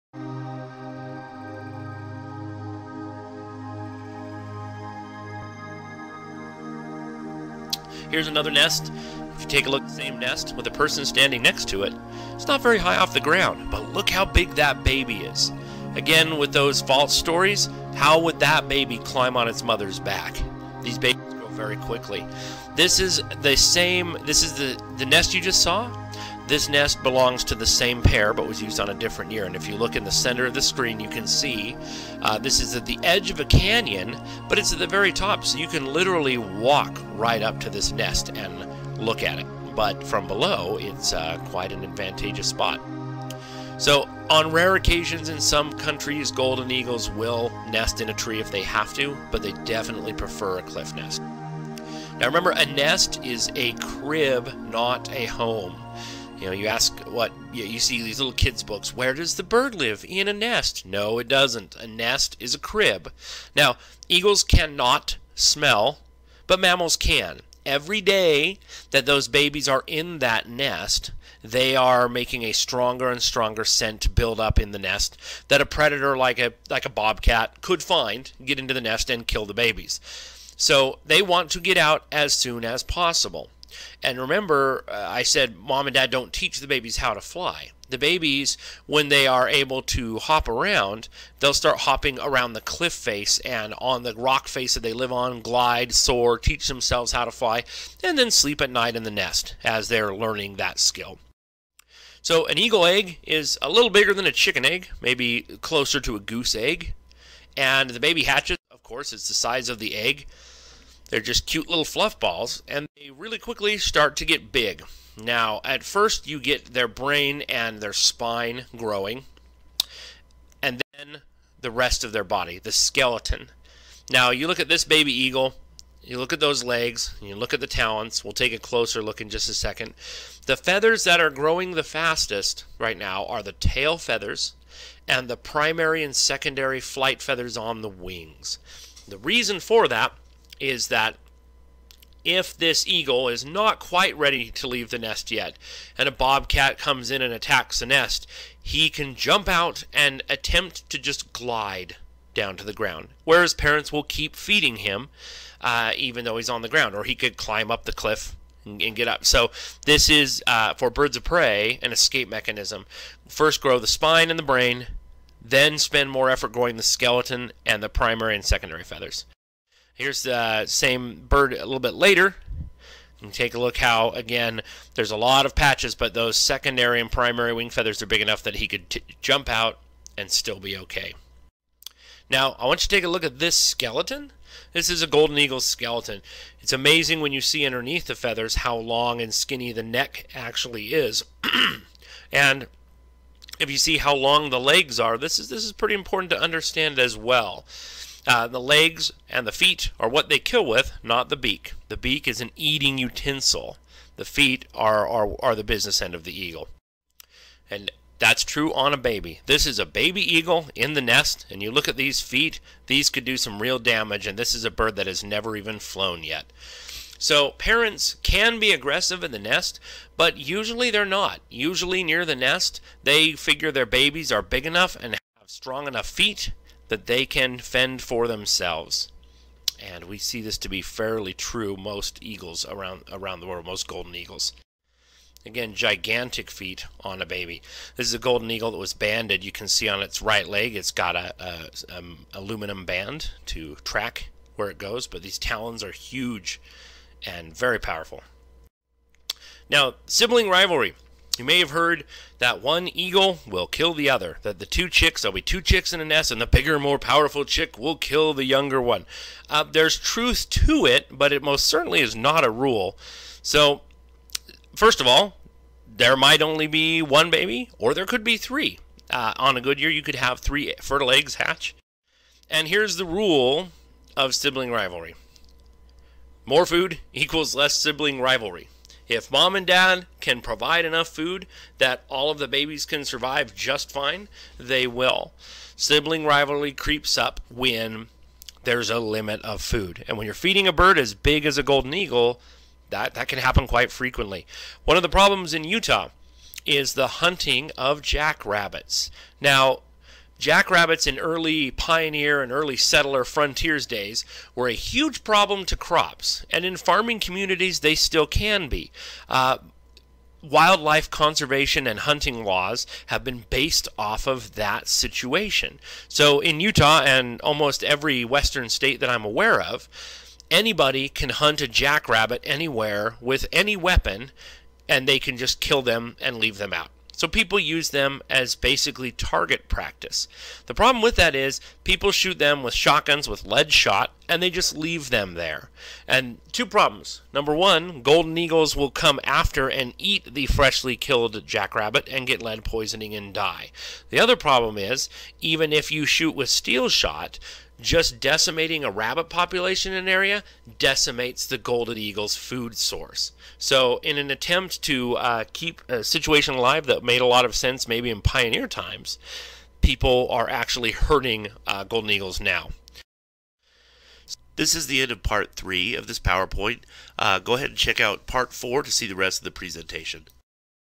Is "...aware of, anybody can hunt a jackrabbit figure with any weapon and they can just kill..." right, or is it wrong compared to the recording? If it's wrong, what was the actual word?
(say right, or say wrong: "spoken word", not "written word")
wrong: "anywhere", not "figure".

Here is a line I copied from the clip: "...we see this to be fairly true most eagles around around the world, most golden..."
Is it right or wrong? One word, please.
right.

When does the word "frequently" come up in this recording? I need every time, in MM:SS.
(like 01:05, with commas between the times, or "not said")
04:53.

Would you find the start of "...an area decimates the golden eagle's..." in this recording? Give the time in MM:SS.
05:49.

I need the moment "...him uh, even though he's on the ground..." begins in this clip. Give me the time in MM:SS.
02:34.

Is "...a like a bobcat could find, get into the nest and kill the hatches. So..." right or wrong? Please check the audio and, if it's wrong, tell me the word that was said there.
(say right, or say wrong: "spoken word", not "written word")
wrong: "babies", not "hatches".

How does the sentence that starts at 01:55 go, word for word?
Now, at first, you get their brain and their spine growing, and then the rest of their body, the skeleton.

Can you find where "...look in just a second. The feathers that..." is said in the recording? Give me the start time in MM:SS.
02:09.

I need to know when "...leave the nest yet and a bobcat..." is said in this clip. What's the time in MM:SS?
02:24.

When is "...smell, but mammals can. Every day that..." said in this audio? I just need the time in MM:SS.
01:05.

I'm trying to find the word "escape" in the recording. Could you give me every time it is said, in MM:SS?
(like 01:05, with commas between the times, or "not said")
02:41.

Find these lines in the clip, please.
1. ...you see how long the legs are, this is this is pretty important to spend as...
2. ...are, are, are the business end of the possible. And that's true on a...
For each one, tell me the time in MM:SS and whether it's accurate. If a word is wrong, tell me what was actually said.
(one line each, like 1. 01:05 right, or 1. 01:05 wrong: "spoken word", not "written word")
1. 03:13 wrong: "understand", not "spend"
2. 03:24 wrong: "eagle", not "possible".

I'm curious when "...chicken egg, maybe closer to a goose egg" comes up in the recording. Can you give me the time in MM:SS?
01:44.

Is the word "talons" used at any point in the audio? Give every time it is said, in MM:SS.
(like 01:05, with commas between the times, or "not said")
02:07, 04:05.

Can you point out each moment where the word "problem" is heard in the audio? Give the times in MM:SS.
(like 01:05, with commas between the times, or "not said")
04:55, 05:05, 05:30, 05:36, 05:44.